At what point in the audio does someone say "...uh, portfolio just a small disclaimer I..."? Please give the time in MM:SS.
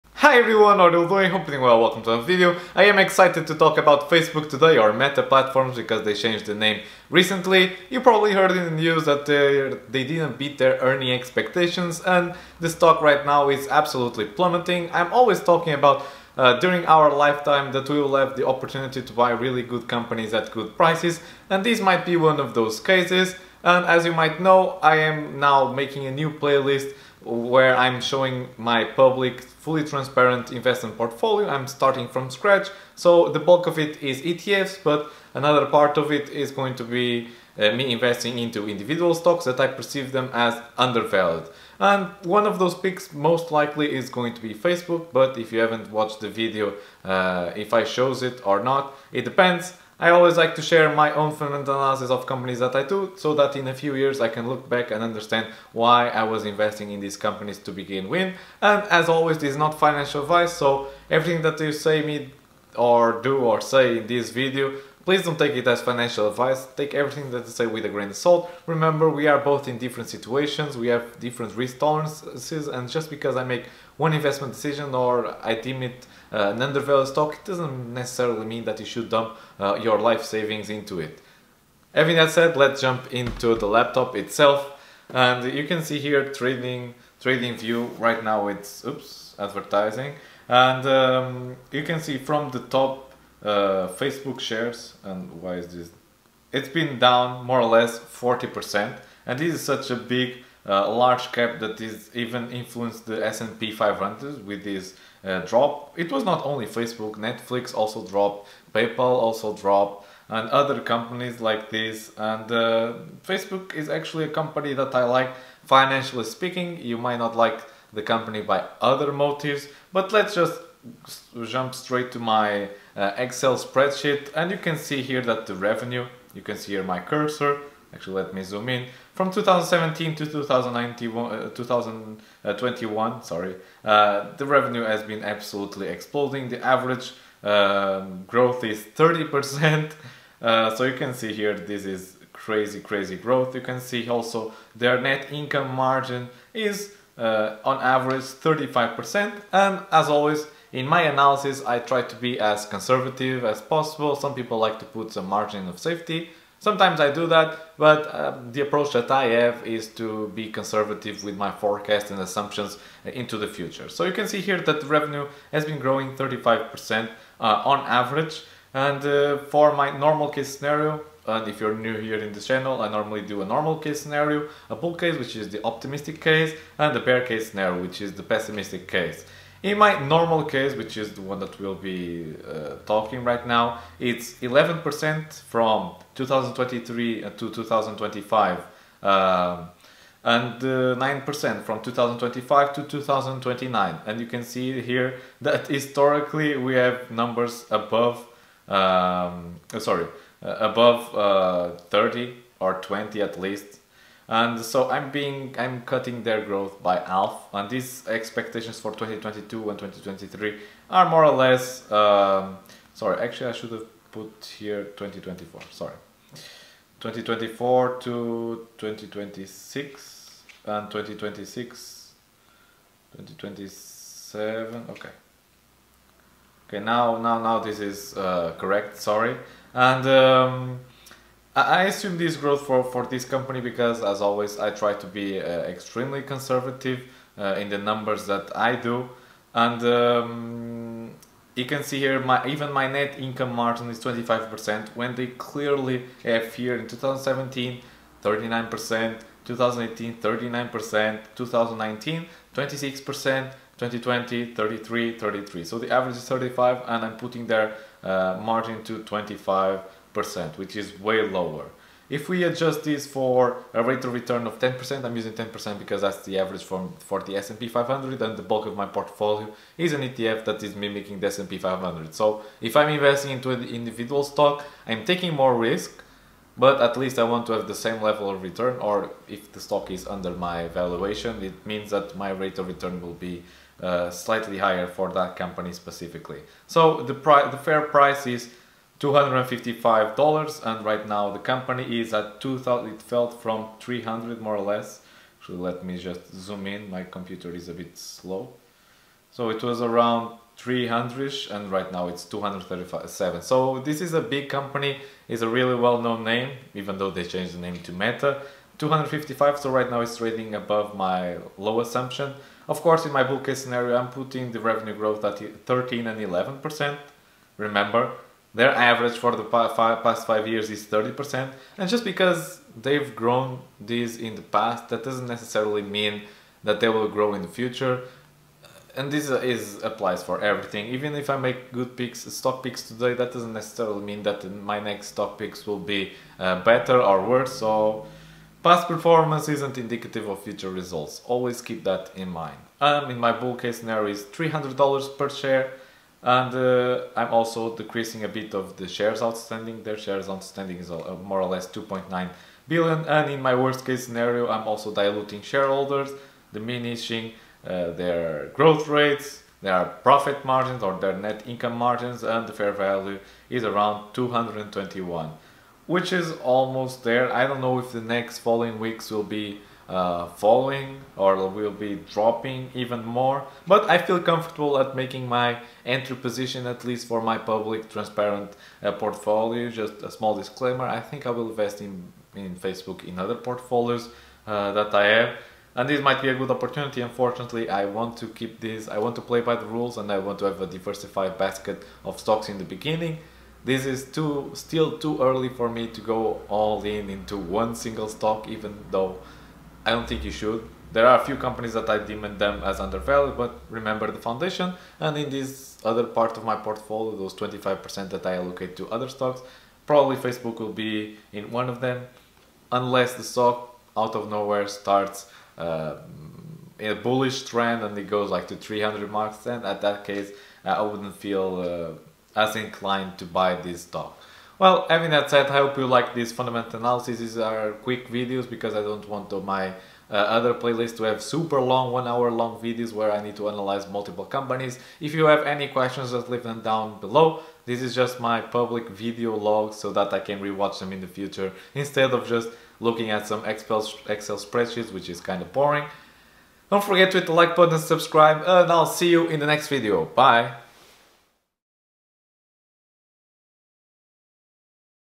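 06:18.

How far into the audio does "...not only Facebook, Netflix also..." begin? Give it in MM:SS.
01:46.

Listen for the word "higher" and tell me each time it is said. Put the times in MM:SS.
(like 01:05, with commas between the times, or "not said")
04:44.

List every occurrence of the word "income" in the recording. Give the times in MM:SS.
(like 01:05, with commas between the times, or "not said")
02:25, 04:03, 06:01.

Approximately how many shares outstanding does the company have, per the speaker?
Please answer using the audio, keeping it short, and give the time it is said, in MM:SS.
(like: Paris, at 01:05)
2.9 billion, at 05:51.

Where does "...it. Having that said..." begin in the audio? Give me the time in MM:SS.
01:20.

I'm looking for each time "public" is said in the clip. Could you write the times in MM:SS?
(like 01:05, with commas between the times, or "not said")
00:28, 06:17, 07:18.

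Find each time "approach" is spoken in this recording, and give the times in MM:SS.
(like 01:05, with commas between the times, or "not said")
02:38.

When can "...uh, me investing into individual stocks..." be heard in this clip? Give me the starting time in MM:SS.
00:37.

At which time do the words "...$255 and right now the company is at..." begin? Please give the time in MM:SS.
04:49.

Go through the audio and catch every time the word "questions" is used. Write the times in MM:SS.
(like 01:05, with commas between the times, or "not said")
07:15.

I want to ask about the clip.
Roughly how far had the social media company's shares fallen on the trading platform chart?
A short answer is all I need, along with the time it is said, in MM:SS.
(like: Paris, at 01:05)
40%, at 01:37.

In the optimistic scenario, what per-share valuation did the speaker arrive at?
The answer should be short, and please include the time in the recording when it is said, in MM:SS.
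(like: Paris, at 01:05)
$300, at 05:44.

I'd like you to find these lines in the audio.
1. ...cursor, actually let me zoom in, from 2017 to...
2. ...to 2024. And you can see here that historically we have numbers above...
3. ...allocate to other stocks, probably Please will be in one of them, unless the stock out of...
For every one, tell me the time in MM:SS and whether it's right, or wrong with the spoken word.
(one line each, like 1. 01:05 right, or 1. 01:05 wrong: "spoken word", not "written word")
1. 02:06 right
2. 03:12 wrong: "2029", not "2024"
3. 06:48 wrong: "Facebook", not "Please".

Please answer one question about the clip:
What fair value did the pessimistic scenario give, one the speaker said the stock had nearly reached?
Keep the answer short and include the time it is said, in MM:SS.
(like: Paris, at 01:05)
221, at 06:04.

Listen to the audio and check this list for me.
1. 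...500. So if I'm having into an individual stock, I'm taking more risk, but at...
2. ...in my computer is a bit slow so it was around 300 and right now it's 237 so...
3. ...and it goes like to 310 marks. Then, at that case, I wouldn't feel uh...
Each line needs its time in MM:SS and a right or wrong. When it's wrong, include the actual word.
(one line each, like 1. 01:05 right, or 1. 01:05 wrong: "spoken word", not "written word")
1. 04:31 wrong: "investing", not "having"
2. 04:56 right
3. 06:57 wrong: "300", not "310".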